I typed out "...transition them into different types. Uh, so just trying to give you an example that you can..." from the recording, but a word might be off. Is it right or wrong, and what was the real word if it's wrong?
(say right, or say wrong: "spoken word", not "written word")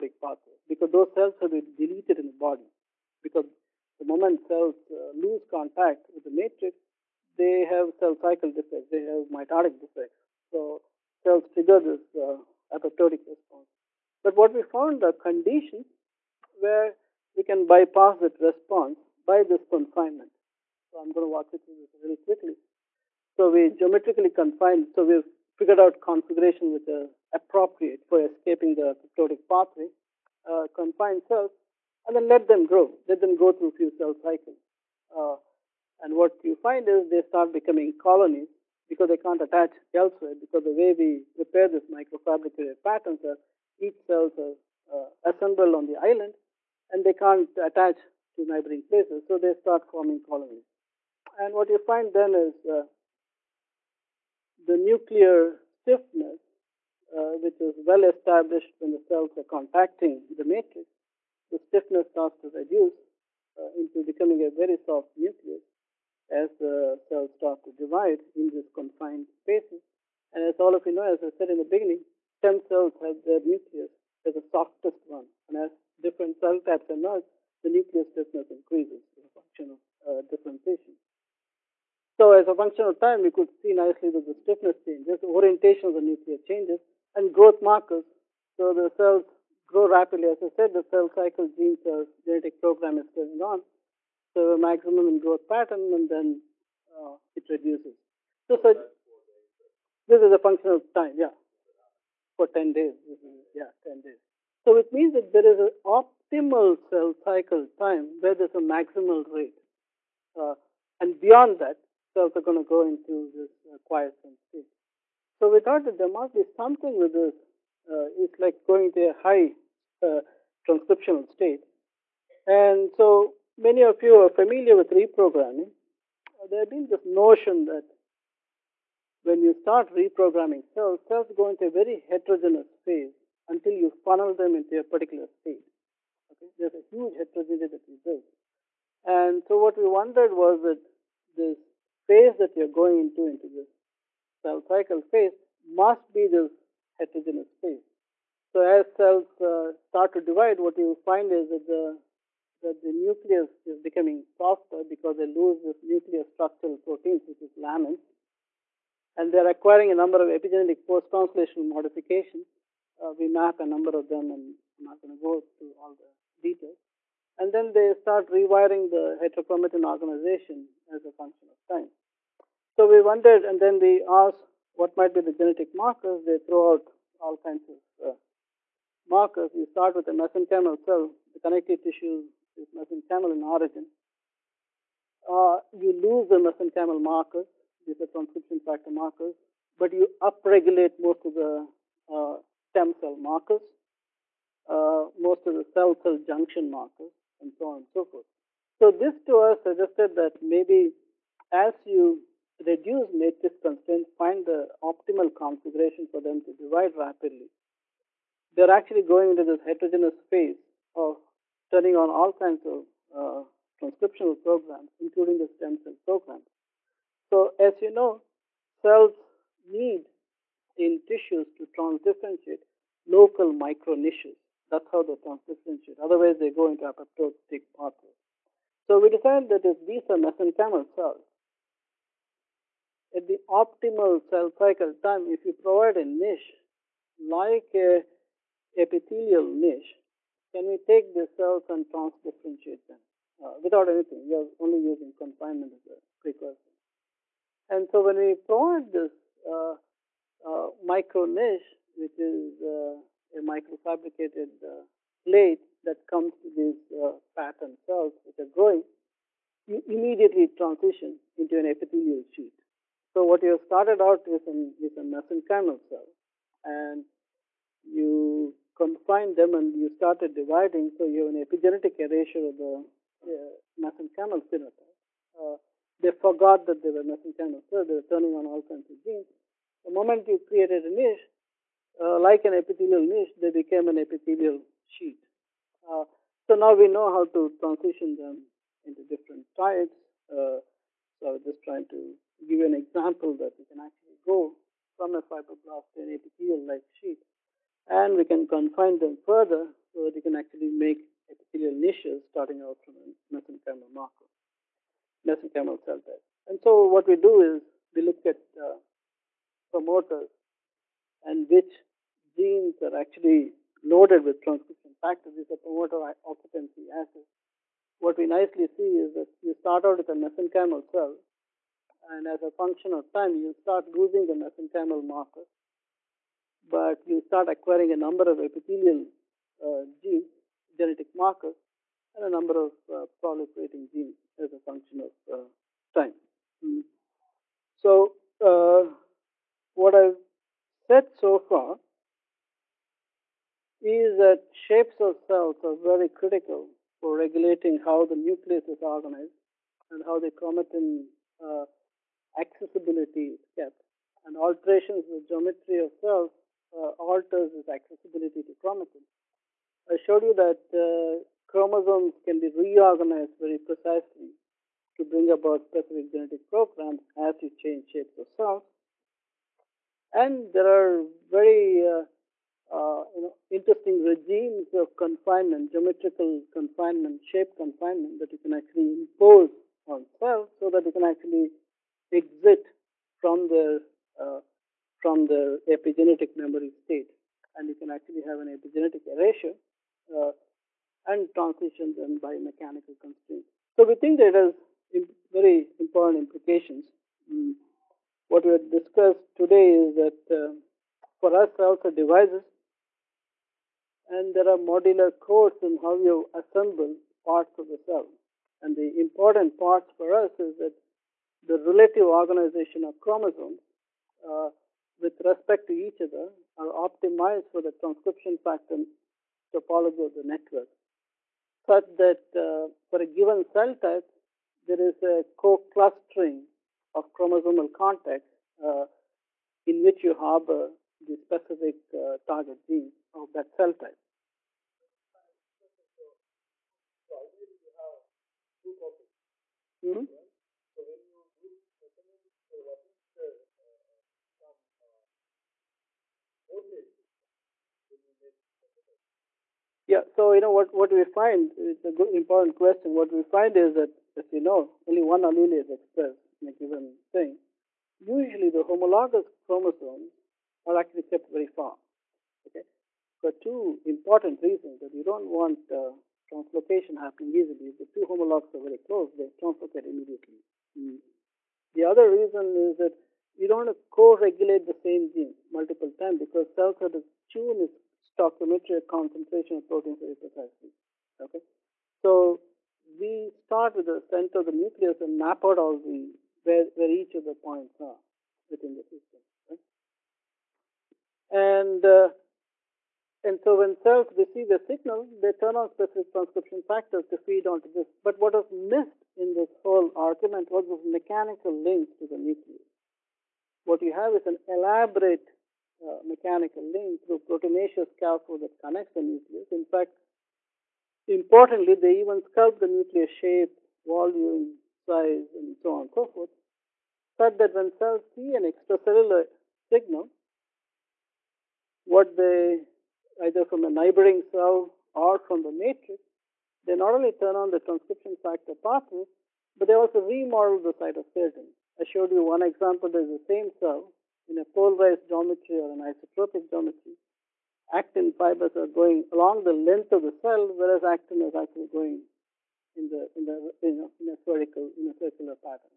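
right.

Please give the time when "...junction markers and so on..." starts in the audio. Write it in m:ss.
3:16.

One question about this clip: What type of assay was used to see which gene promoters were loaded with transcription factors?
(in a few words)
Promoter occupancy assays.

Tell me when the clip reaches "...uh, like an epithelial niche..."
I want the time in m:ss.
4:42.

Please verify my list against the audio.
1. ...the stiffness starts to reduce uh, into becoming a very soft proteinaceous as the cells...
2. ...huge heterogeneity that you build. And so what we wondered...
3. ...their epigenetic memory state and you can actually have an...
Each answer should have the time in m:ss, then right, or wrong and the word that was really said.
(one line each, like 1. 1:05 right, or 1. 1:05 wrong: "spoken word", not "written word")
1. 1:01 wrong: "nucleus", not "proteinaceous"
2. 2:16 right
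3. 6:25 right.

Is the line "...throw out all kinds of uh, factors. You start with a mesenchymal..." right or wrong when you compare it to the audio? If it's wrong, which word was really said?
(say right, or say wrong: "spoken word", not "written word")
wrong: "markers", not "factors".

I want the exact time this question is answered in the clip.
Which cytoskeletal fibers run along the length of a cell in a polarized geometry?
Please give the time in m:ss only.
8:57.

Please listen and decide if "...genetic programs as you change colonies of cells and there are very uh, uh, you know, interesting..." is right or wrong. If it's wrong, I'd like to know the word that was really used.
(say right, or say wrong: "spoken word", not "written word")
wrong: "shapes", not "colonies".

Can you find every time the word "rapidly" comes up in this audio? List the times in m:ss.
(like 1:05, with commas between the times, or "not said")
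1:29, 3:26.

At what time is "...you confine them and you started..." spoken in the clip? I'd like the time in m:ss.
4:27.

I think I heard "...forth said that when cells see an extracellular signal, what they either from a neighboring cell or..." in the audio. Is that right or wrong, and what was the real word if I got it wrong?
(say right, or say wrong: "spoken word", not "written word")
right.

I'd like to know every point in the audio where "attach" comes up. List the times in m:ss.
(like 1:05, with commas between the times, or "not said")
0:39, 0:47.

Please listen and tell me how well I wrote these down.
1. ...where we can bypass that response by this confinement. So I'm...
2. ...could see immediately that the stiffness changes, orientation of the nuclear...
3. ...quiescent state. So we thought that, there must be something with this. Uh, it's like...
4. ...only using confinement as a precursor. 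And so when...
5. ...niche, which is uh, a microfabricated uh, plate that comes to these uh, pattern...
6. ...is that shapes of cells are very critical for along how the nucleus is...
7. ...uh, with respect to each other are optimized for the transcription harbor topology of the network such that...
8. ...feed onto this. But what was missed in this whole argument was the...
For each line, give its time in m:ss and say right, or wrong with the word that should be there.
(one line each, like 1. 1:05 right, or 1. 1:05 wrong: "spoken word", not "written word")
1. 0:16 right
2. 1:23 wrong: "nicely", not "immediately"
3. 1:53 right
4. 4:04 right
5. 4:11 right
6. 5:43 wrong: "regulating", not "along"
7. 6:54 wrong: "factor", not "harbor"
8. 8:17 right.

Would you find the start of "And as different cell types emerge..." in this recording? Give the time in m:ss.
1:15.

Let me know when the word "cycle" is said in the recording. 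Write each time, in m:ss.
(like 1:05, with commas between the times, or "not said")
0:08, 0:34, 1:31, 1:47, 2:24, 3:54.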